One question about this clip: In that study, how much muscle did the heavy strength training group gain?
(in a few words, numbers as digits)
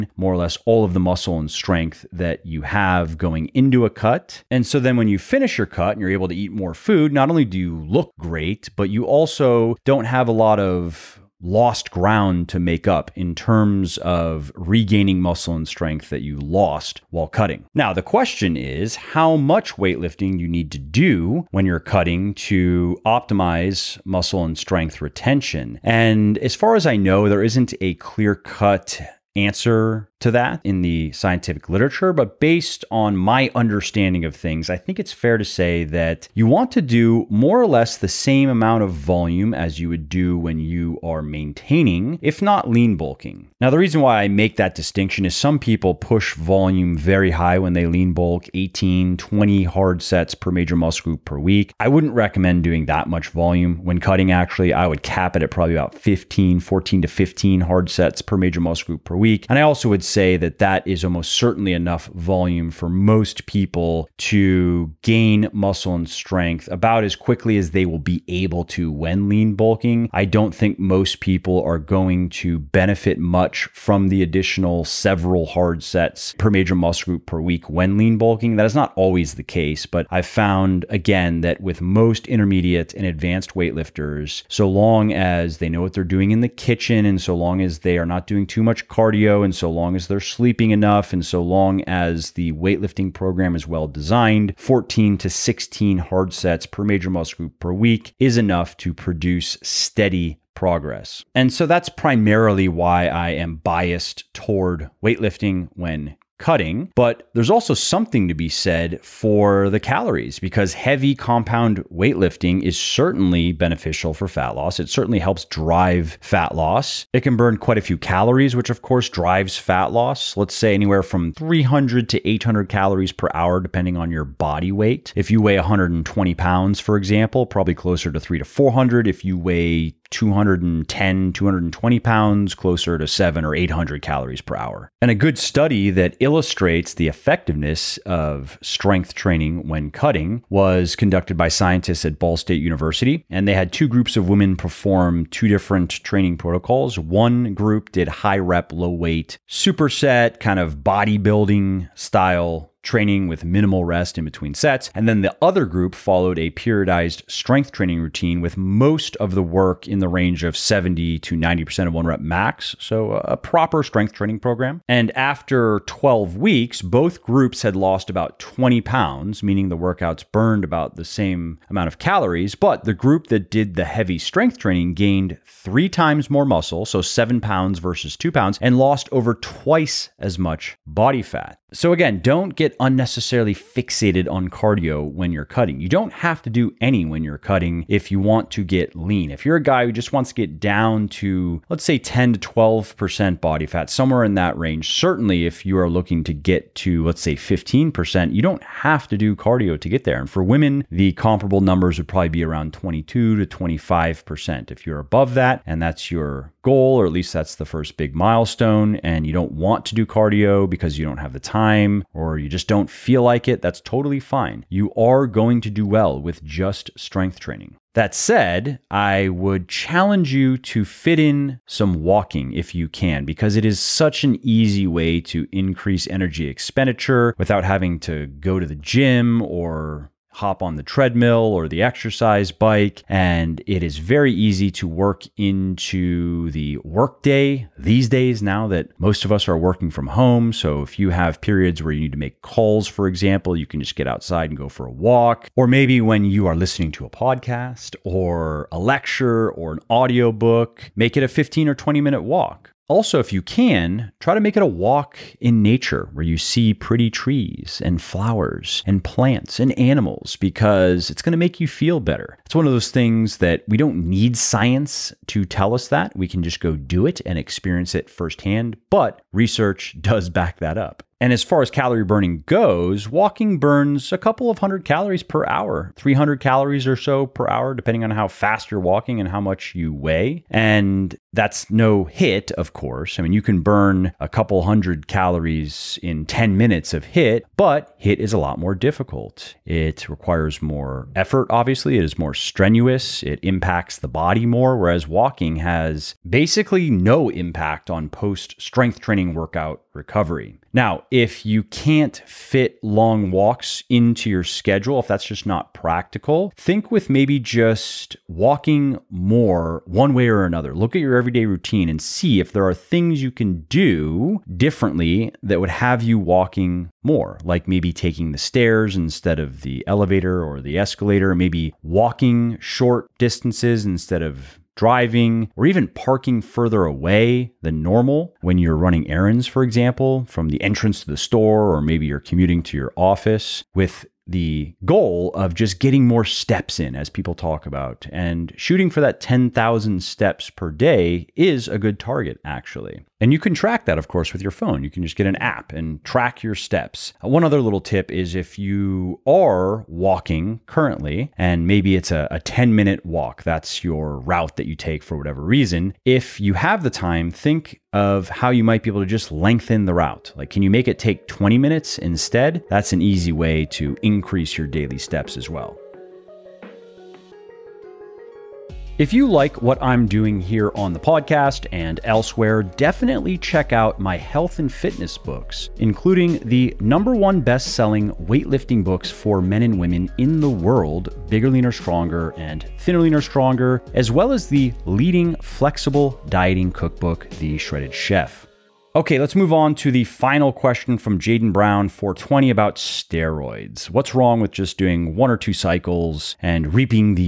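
7 pounds.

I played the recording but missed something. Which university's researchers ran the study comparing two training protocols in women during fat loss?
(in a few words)
Ball State University.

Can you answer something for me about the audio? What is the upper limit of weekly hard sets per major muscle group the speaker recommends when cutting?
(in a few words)
15.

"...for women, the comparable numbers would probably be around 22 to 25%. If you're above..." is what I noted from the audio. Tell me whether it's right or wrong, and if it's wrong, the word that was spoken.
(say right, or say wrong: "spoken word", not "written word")
right.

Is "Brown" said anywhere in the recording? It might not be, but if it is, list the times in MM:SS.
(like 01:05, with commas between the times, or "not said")
06:31.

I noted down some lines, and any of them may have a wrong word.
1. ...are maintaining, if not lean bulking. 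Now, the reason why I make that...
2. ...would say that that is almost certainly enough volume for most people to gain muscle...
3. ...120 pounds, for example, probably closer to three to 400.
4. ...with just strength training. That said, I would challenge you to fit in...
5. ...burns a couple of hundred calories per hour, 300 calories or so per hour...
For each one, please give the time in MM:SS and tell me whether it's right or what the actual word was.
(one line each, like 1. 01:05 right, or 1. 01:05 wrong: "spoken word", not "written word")
1. 00:41 right
2. 00:59 right
3. 02:05 right
4. 03:36 right
5. 04:33 right.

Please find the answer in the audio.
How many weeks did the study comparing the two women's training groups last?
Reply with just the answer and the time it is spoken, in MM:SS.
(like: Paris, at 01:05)
12, at 02:45.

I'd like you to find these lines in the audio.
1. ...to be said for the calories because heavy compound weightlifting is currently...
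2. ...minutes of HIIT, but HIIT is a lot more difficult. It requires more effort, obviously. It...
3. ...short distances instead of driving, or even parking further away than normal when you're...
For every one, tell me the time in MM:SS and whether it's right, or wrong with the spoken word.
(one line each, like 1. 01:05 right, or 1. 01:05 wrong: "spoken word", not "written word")
1. 01:48 wrong: "certainly", not "currently"
2. 04:46 right
3. 05:22 right.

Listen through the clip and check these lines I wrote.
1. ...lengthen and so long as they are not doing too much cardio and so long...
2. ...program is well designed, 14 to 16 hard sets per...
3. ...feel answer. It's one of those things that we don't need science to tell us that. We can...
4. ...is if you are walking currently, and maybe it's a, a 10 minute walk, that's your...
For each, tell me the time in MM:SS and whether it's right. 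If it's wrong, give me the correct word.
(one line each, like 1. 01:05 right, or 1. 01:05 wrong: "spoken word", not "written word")
1. 01:26 wrong: "kitchen", not "lengthen"
2. 01:33 right
3. 04:21 wrong: "better", not "answer"
4. 05:48 right.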